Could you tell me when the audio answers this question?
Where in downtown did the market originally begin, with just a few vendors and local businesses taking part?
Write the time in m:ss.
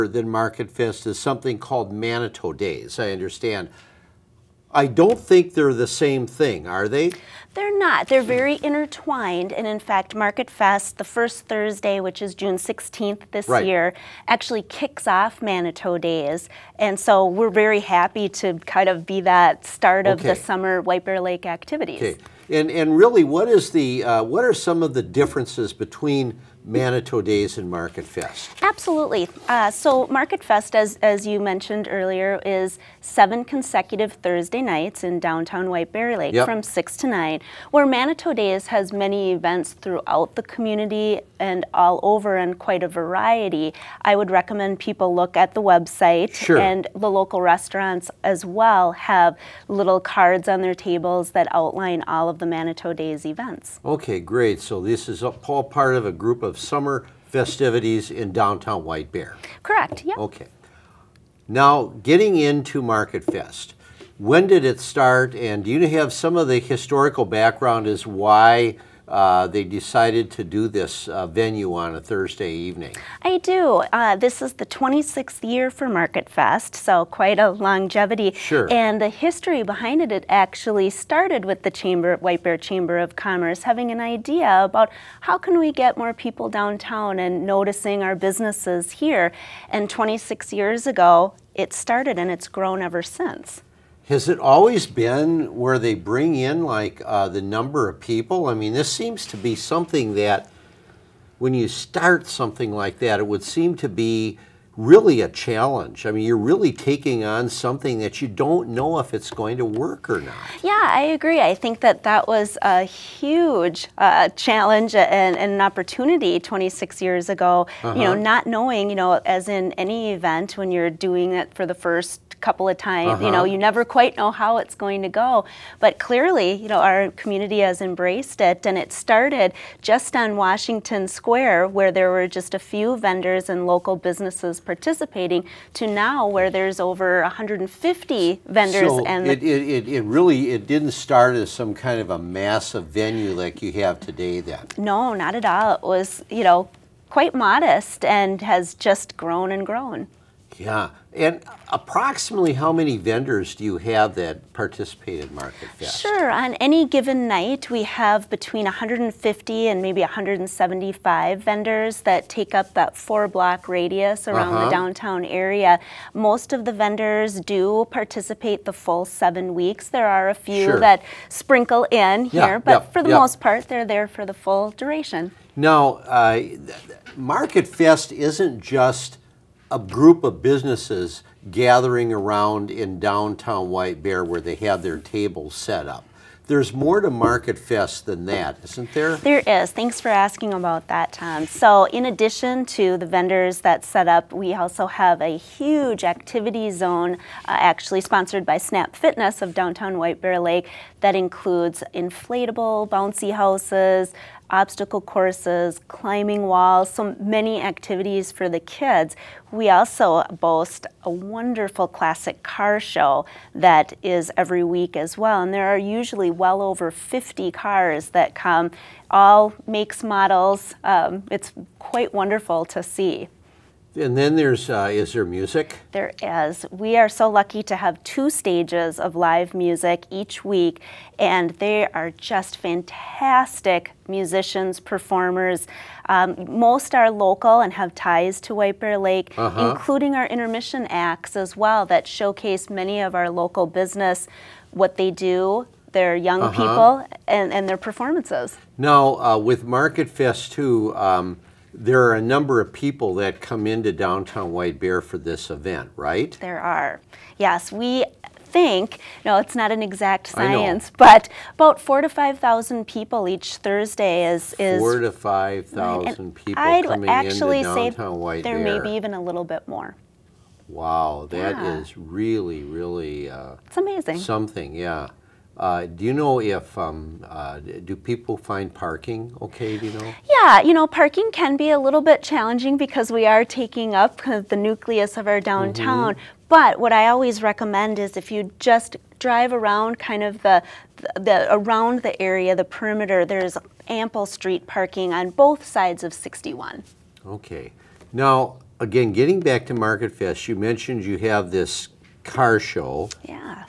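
2:10.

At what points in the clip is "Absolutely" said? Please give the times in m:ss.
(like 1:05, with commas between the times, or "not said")
0:28.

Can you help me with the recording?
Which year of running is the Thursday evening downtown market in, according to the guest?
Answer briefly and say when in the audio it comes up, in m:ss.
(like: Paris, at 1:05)
26th, at 1:14.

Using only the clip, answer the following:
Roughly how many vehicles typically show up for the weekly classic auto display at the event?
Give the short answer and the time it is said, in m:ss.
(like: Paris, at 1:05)
over 50, at 3:36.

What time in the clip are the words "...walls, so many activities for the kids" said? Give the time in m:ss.
3:26.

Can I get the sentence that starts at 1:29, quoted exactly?
And 26 years ago, it started and it's grown ever since.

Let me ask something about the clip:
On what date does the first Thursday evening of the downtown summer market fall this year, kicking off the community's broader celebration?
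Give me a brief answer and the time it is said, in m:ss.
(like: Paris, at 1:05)
June 16th, at 0:12.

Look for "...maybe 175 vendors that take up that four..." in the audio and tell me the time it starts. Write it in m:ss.
2:39.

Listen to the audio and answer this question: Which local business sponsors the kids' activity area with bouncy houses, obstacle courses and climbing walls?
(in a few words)
Snap Fitness.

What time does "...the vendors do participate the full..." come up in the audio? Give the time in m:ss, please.
2:46.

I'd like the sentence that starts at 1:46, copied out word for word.
I mean, you're really taking on something that you don't know if it's going to work or not.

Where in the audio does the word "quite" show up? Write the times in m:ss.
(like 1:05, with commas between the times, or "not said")
0:42, 1:17, 2:03, 2:27, 3:41.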